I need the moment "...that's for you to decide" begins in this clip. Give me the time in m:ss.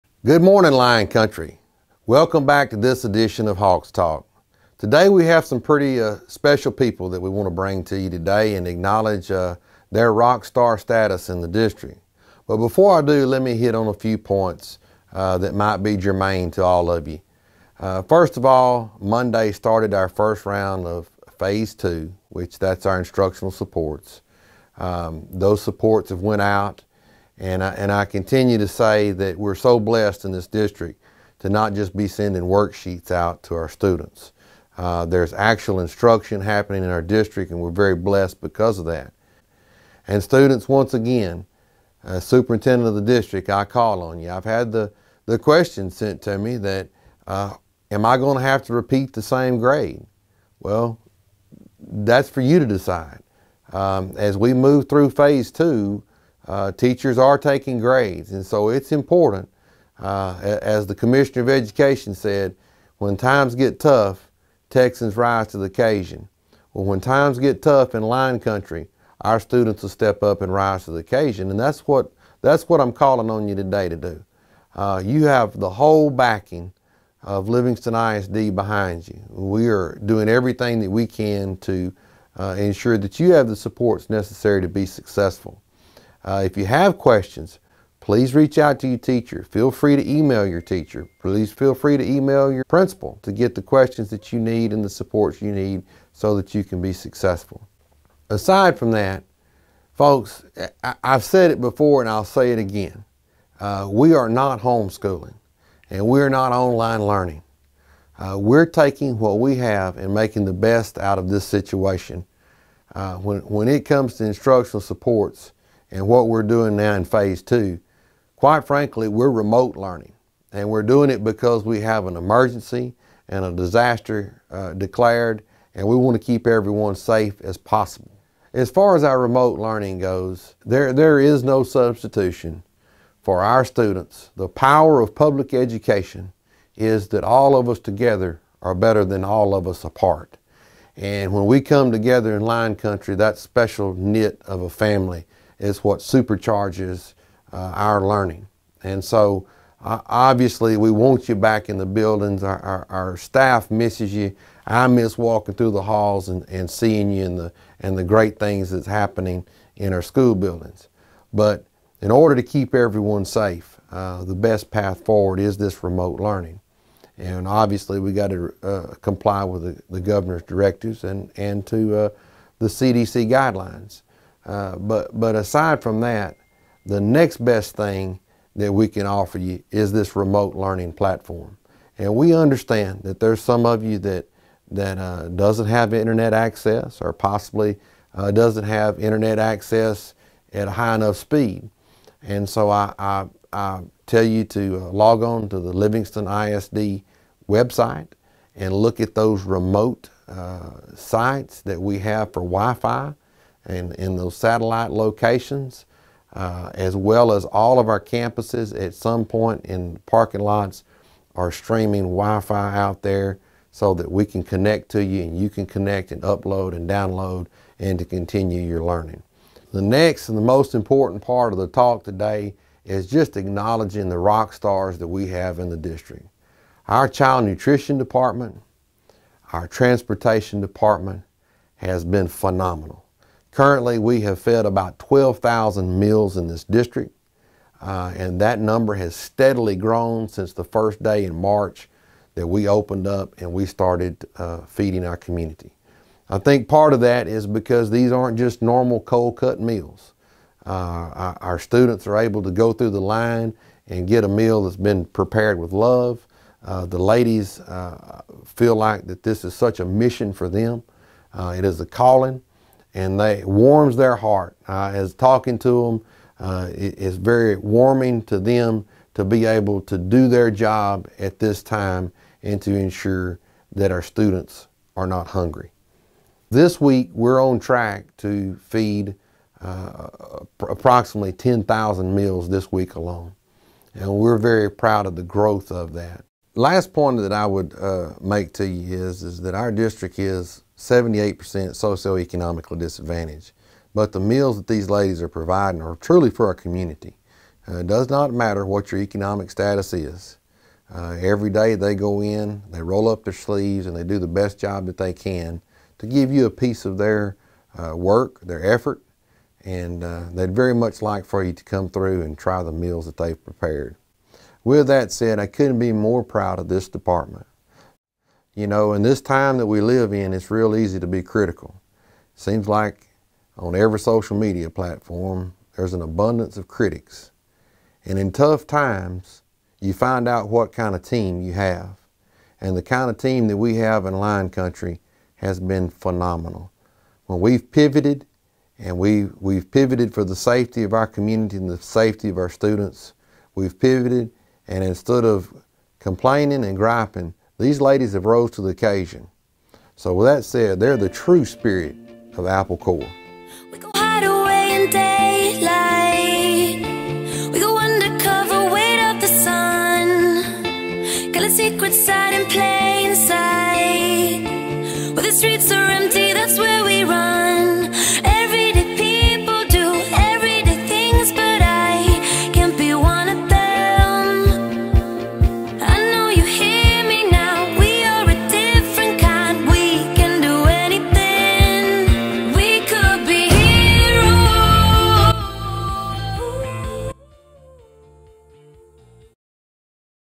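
0:51.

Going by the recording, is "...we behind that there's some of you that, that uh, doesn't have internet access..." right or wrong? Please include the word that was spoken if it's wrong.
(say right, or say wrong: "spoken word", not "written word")
wrong: "understand", not "behind".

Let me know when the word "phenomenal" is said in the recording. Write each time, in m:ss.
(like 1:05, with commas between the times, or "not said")
3:52, 5:35.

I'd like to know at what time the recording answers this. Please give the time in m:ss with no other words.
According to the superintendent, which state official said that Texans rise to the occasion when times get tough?
1:00.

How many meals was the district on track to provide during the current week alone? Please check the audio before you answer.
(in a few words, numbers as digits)
10,000.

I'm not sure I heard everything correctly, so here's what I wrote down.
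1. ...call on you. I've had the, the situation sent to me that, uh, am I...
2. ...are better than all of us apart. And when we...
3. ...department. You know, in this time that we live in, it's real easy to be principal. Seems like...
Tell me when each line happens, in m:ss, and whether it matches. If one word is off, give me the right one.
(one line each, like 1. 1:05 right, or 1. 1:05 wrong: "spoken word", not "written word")
1. 0:43 wrong: "question", not "situation"
2. 2:18 right
3. 5:16 wrong: "critical", not "principal".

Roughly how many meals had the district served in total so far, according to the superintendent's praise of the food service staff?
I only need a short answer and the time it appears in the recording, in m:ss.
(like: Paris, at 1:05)
12,000, at 3:54.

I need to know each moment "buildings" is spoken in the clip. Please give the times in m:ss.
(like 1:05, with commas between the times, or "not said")
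2:31, 2:40.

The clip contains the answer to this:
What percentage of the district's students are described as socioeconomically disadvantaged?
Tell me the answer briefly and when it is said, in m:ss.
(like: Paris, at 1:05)
78%, at 4:50.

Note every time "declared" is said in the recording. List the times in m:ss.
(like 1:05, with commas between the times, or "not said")
2:04.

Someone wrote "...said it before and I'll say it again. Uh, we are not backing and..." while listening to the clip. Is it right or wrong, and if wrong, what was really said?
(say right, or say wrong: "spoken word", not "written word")
wrong: "homeschooling", not "backing".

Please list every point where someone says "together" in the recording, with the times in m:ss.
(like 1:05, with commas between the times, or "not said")
2:17, 2:21.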